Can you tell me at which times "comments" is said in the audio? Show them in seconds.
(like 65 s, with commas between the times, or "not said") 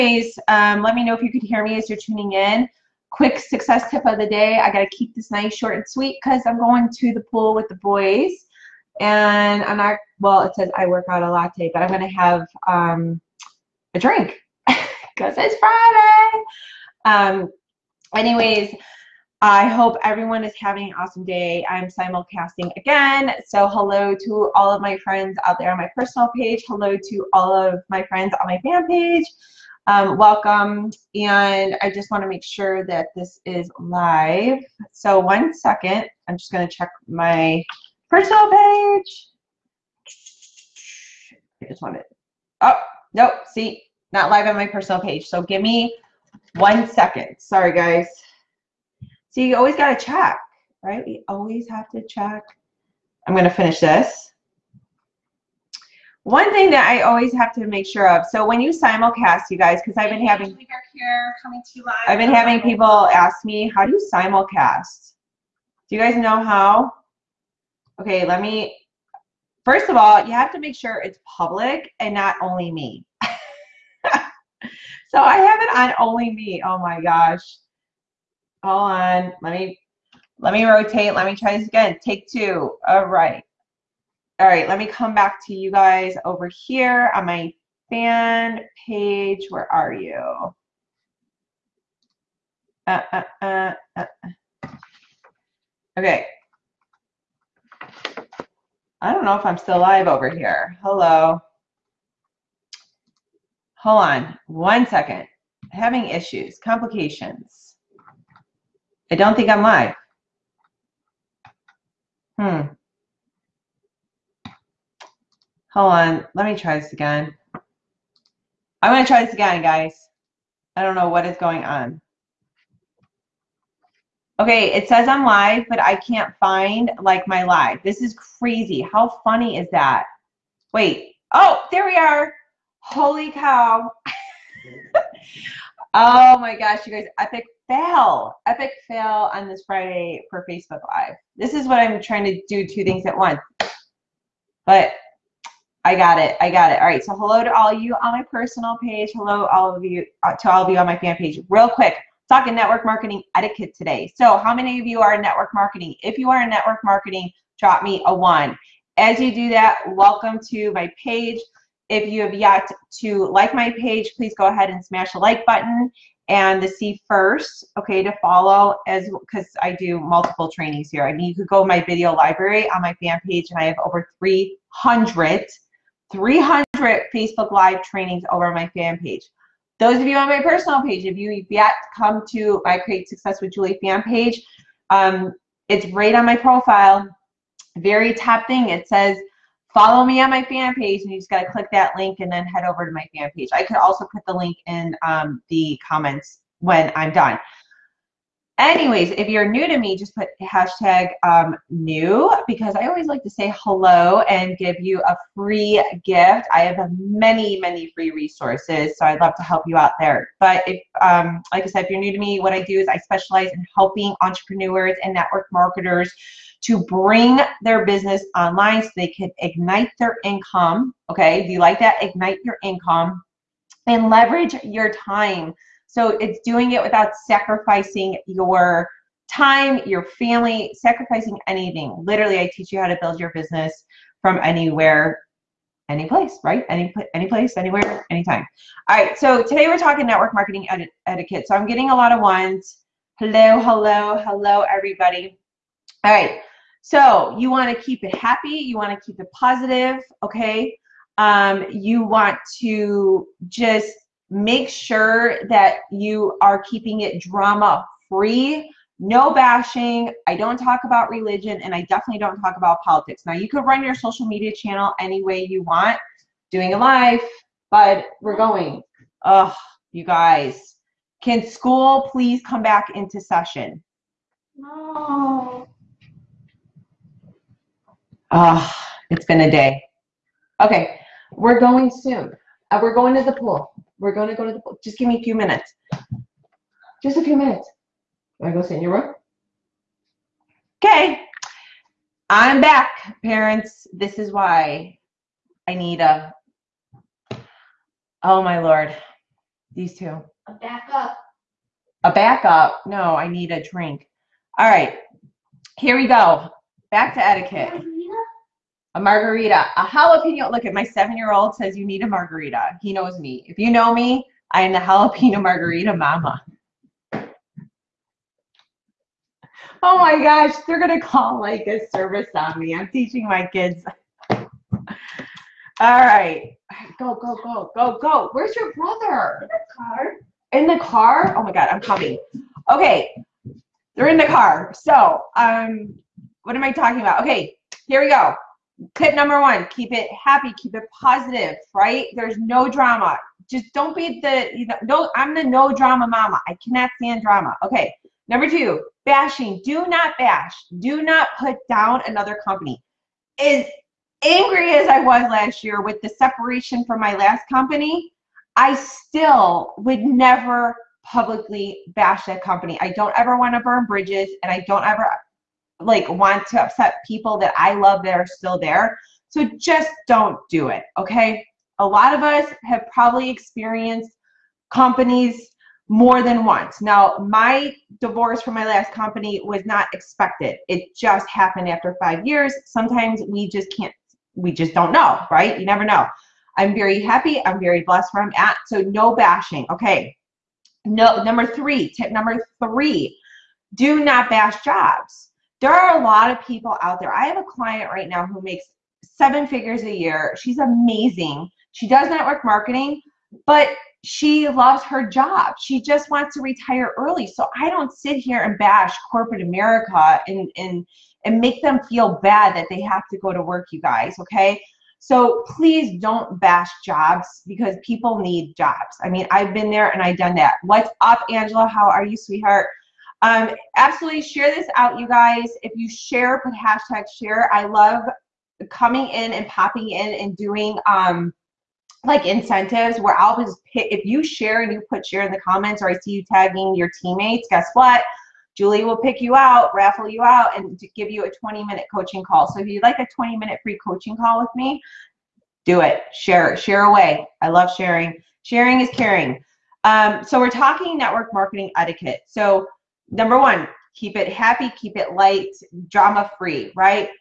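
195 s, 435 s.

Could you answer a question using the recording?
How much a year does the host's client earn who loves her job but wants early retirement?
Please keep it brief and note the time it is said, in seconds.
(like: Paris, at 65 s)
seven figures, at 399 s.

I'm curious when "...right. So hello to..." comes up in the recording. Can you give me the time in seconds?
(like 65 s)
146 s.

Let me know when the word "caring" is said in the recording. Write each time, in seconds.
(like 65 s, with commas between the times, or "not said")
448 s.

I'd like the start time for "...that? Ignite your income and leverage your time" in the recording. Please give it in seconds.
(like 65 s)
221 s.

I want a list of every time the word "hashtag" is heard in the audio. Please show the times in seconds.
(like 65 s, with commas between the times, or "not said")
200 s, 426 s.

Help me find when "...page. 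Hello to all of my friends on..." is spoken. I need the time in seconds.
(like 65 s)
26 s.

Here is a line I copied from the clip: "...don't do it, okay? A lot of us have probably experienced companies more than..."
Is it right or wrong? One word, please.
right.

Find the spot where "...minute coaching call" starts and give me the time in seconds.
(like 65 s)
441 s.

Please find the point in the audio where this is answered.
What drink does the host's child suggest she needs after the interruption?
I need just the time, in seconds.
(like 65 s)
308 s.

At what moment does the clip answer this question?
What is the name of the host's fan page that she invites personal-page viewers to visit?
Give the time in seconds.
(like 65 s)
182 s.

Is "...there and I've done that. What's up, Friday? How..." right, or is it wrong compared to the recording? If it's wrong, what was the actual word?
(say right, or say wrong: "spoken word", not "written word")
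wrong: "Angela", not "Friday".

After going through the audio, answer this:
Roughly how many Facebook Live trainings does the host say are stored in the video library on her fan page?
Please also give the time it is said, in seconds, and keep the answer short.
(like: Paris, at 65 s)
over 300, at 173 s.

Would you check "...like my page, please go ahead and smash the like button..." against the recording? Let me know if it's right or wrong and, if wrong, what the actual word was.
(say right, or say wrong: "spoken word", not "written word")
right.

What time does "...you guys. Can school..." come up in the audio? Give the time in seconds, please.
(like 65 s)
269 s.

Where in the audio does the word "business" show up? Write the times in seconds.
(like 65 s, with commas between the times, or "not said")
217 s, 233 s.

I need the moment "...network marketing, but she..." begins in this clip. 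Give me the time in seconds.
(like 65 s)
402 s.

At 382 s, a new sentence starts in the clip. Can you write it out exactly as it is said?
Sometimes we just can't we just don't know, right?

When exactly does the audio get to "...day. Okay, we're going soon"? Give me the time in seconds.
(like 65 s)
279 s.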